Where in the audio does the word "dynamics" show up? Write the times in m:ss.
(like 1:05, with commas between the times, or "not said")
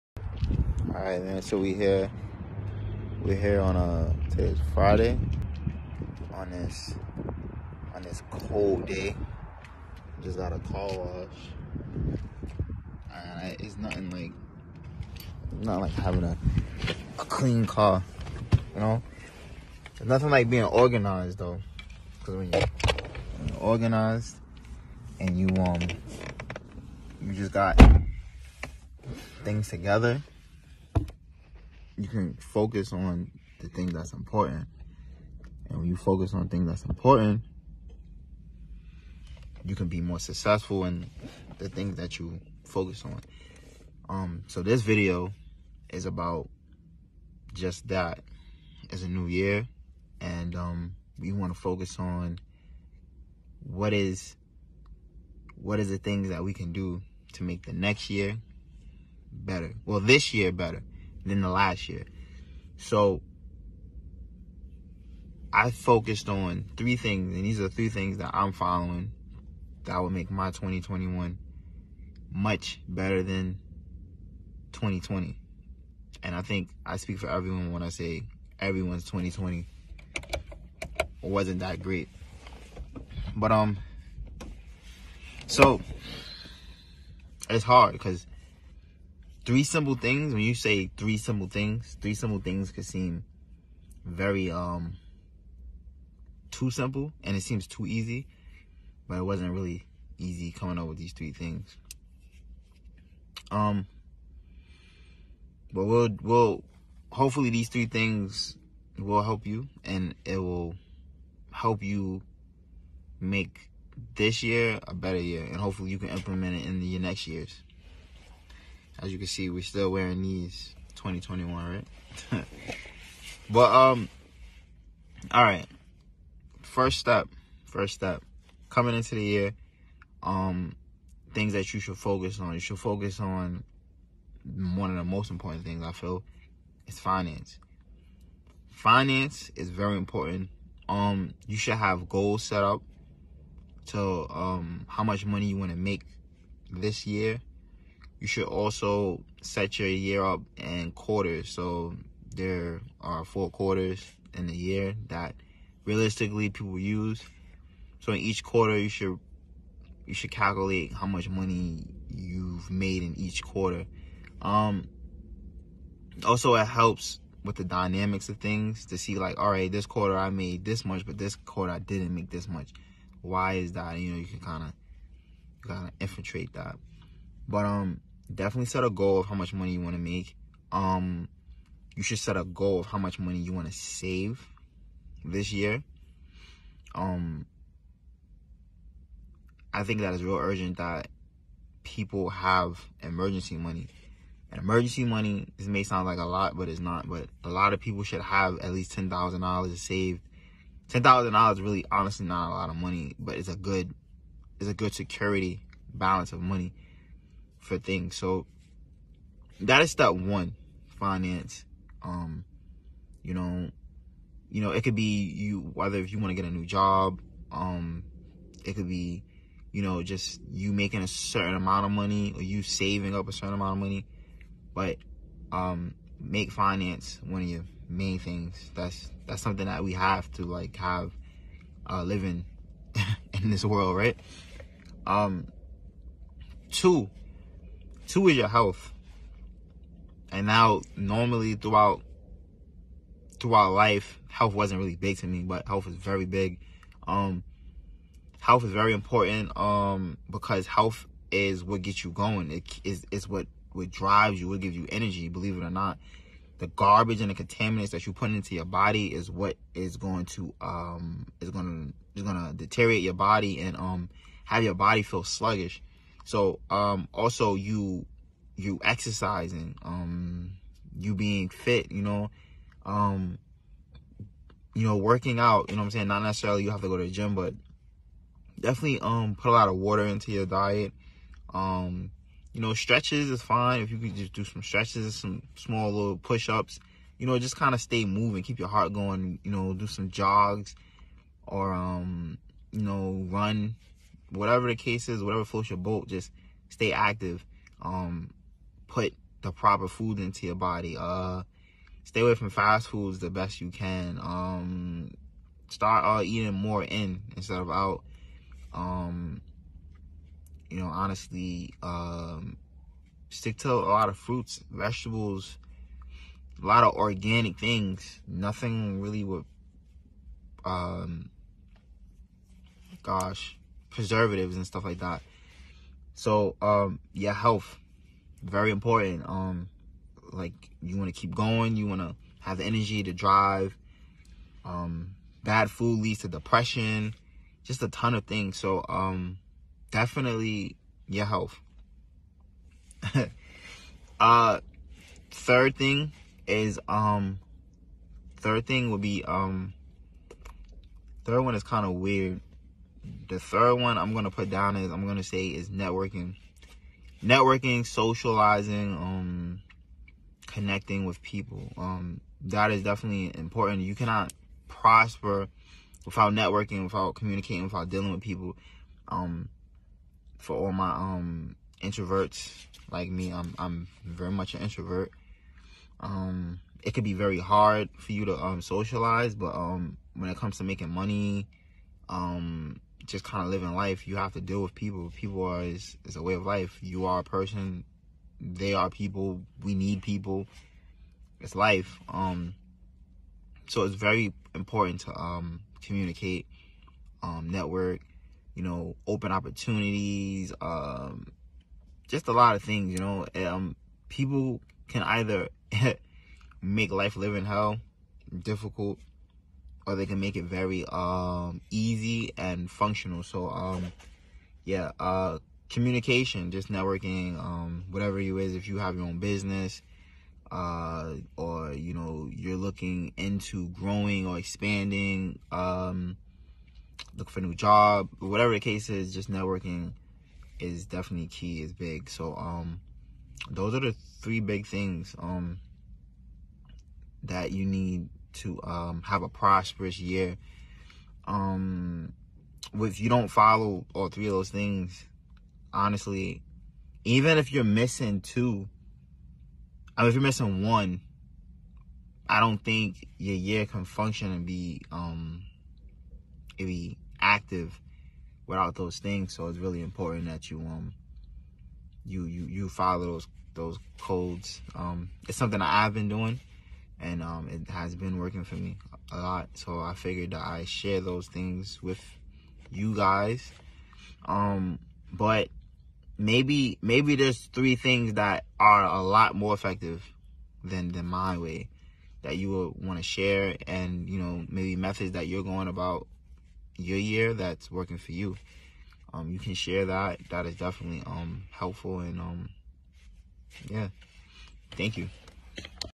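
2:47.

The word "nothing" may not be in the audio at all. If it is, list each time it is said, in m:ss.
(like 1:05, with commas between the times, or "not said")
0:13, 0:20, 5:18.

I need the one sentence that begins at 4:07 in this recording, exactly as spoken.
Um, health is very important um, because health is what gets you going.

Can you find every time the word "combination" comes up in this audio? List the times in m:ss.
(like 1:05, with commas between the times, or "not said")
not said.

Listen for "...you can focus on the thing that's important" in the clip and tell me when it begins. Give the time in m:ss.
0:32.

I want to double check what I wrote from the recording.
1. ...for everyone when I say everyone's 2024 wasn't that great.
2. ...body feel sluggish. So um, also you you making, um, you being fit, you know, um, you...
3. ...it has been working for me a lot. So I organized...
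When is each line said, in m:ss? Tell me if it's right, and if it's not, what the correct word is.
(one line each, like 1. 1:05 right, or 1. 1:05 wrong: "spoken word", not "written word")
1. 1:17 wrong: "2020", not "2024"
2. 4:24 wrong: "exercising", not "making"
3. 7:47 wrong: "figured", not "organized".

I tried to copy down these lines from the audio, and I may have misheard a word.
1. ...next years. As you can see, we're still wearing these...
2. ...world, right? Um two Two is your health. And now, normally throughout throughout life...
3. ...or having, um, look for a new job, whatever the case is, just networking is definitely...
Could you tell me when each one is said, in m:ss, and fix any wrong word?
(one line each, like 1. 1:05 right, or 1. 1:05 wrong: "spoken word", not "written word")
1. 1:57 right
2. 3:53 right
3. 7:04 wrong: "expanding", not "having".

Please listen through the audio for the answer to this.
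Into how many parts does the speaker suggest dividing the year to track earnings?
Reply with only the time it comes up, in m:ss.
2:33.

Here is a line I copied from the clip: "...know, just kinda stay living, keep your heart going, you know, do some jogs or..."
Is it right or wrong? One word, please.
wrong.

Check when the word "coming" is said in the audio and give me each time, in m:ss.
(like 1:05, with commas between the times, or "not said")
1:40, 2:08.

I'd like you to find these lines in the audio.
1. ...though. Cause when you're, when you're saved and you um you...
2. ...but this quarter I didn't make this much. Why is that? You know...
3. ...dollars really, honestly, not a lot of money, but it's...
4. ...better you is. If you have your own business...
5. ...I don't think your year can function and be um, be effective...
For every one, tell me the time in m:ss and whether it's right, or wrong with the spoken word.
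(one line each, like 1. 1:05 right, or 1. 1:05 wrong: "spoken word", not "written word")
1. 0:21 wrong: "organized", not "saved"
2. 2:51 right
3. 3:21 right
4. 6:57 wrong: "whatever", not "better"
5. 7:32 wrong: "active", not "effective".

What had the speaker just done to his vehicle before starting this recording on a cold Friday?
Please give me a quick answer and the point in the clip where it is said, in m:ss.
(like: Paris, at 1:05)
Car wash, at 0:10.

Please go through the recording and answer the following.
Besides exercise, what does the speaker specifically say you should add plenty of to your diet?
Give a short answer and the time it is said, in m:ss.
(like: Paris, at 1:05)
Water, at 4:39.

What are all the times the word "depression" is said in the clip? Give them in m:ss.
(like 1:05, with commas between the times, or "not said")
5:36.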